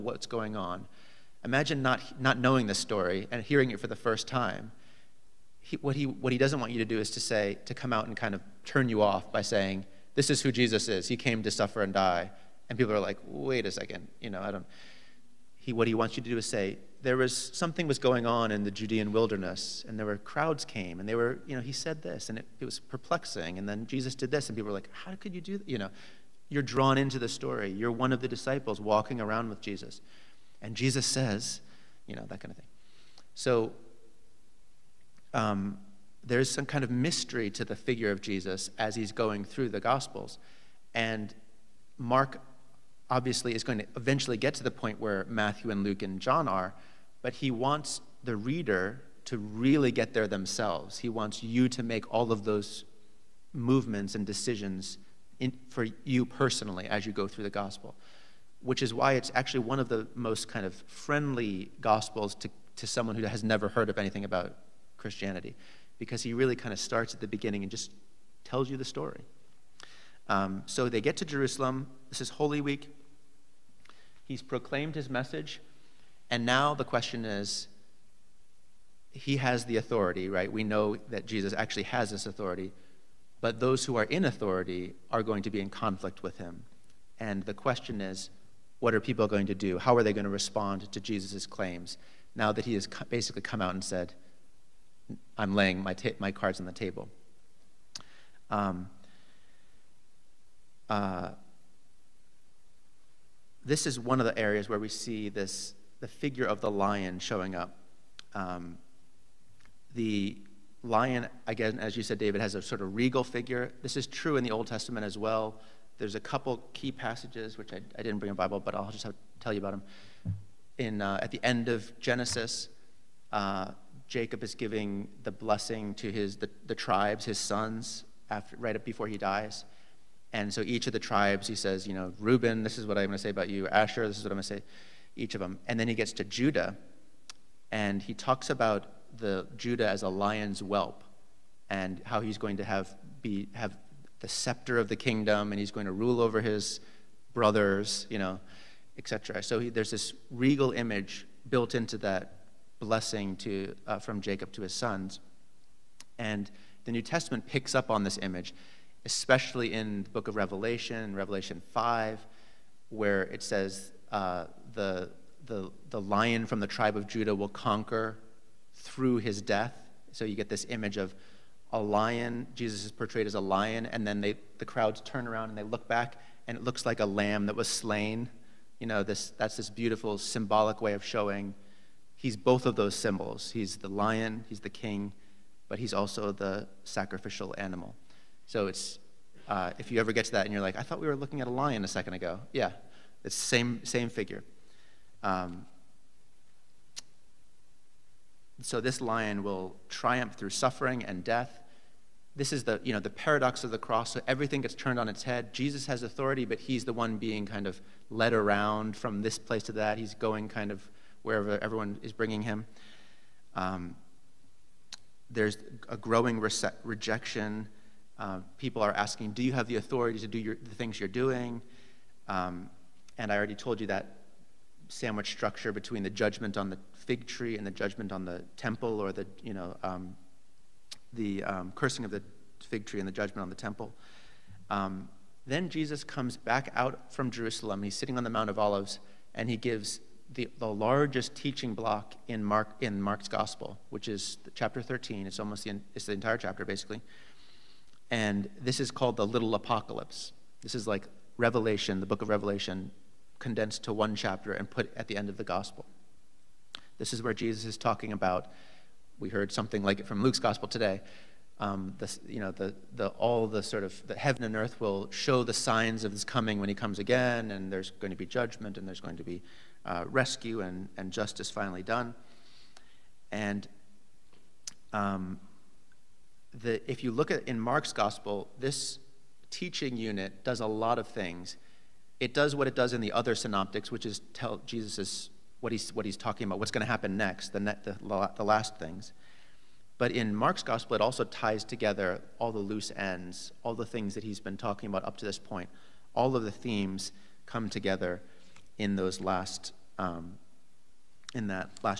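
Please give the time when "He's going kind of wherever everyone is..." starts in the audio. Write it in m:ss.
3:29.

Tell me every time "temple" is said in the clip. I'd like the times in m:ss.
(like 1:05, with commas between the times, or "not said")
3:48, 3:53.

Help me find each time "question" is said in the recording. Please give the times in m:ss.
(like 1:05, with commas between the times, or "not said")
1:16, 1:27.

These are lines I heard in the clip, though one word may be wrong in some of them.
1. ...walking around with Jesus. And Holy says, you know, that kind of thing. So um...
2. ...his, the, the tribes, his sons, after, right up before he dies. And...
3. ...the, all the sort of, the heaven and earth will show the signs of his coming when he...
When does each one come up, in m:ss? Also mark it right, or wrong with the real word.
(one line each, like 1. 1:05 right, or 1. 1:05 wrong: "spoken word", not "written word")
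1. 0:28 wrong: "Jesus", not "Holy"
2. 2:06 right
3. 4:22 right.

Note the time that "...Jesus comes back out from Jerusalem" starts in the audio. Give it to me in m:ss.
3:55.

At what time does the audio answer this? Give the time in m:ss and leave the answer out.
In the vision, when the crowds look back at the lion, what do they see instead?
2:56.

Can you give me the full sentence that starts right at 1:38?
Um, uh, this is one of the areas where we see this the figure of the lion showing up.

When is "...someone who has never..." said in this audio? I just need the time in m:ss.
1:02.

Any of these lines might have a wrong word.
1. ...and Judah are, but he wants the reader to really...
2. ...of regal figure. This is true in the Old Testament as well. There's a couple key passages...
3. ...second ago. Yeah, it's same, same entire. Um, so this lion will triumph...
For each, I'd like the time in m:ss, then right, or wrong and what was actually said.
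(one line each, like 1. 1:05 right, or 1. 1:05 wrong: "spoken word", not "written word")
1. 0:46 wrong: "John", not "Judah"
2. 1:52 right
3. 3:11 wrong: "figure", not "entire".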